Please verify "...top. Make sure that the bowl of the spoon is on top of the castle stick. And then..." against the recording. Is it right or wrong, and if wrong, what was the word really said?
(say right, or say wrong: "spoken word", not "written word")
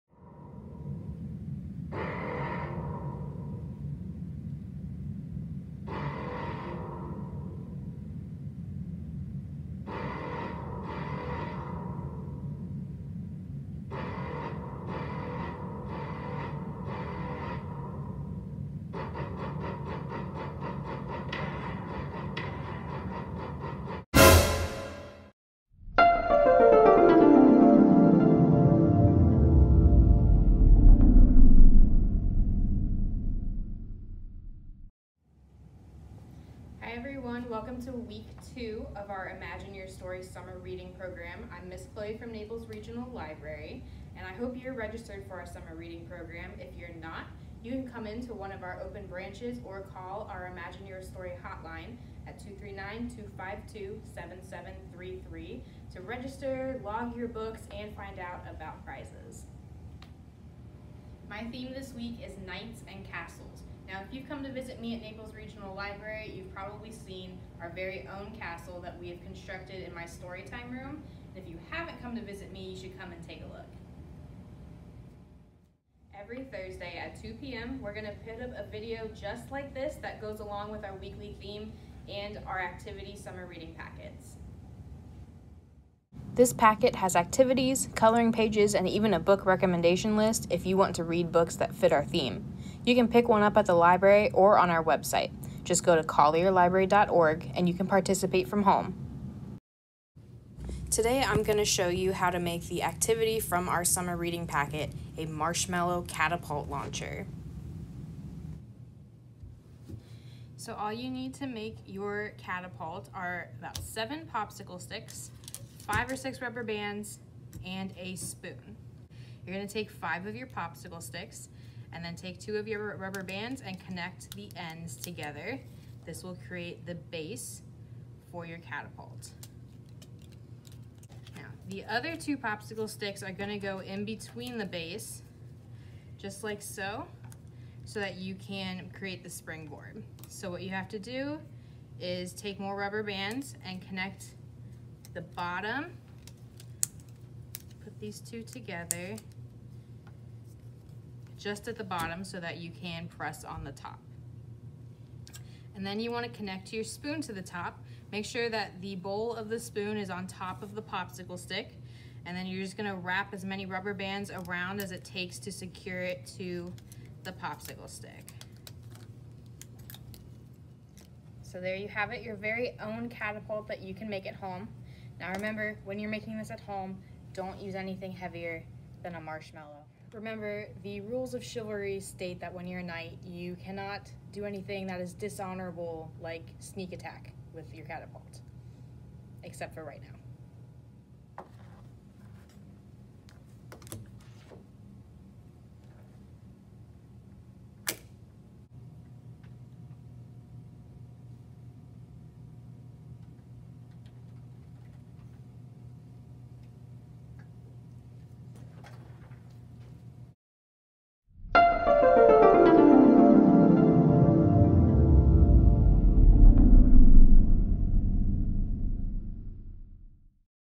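wrong: "popsicle", not "castle".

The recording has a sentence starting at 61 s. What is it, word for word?
My theme this week is Knights and Castles.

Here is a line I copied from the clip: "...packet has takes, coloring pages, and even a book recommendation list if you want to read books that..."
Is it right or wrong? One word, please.
wrong.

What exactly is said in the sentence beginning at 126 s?
This will create the base for your catapult.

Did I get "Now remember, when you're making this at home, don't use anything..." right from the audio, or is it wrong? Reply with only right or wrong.
right.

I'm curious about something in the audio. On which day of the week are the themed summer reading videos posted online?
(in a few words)
Thursday.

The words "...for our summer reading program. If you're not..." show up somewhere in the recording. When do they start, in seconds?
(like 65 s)
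45 s.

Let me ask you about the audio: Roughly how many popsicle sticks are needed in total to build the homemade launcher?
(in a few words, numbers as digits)
7.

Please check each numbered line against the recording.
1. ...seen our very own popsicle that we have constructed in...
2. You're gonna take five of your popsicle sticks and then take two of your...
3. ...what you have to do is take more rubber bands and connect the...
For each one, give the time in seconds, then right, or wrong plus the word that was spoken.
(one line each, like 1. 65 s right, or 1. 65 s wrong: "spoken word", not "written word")
1. 66 s wrong: "castle", not "popsicle"
2. 119 s right
3. 140 s right.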